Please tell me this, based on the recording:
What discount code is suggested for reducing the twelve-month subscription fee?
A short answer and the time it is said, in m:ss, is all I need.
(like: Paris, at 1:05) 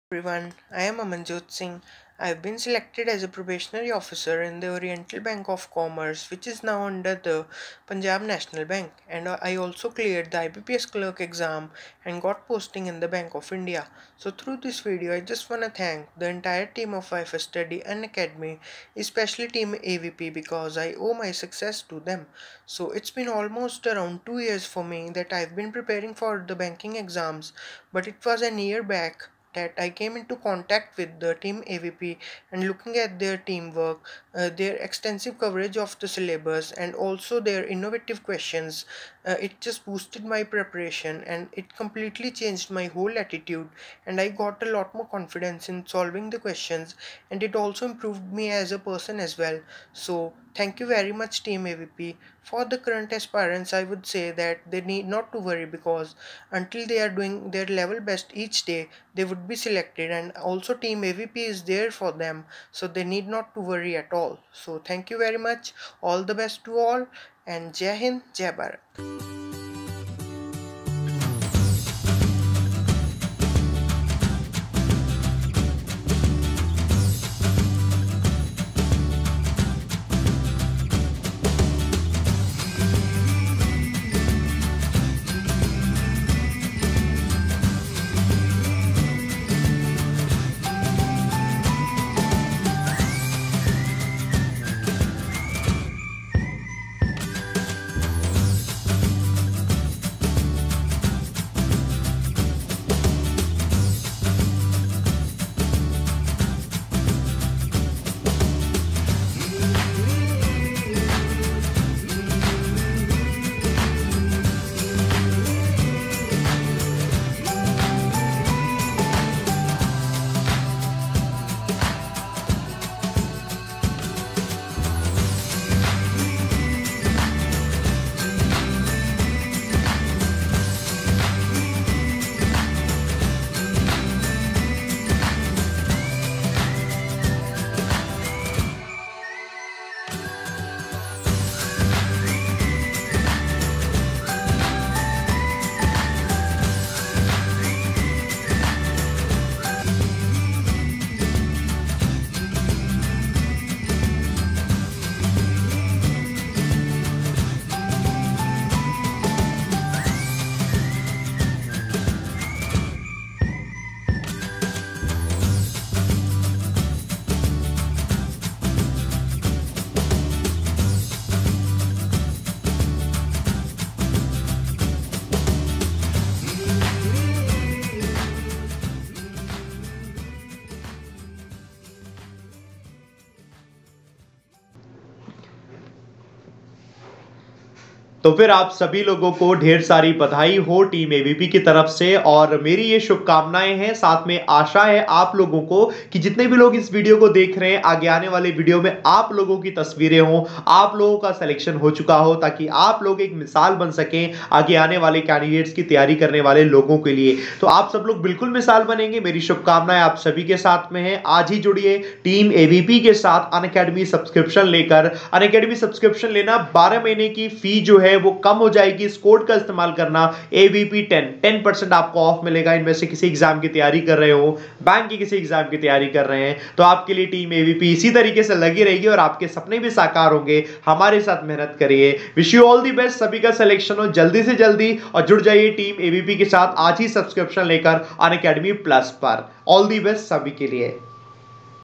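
AVP10, at 3:40.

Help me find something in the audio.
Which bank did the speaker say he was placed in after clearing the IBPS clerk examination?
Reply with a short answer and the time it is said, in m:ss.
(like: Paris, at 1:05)
Bank of India, at 0:13.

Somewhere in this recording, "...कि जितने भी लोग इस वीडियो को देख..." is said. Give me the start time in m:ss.
3:16.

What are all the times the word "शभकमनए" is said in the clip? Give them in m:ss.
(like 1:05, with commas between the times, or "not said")
3:13, 3:29.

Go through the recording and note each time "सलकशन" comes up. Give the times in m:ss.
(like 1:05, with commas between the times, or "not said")
3:21, 3:53.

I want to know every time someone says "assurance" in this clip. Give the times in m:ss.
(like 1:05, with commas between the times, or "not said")
not said.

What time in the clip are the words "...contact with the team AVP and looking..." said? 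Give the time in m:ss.
0:30.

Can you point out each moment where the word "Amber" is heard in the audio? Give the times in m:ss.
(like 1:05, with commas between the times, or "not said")
not said.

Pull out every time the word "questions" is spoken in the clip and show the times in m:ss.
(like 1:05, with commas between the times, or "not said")
0:38, 0:46.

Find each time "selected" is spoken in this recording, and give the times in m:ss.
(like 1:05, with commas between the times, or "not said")
0:02, 0:59.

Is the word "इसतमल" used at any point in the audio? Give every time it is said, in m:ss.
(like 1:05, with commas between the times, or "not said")
3:39.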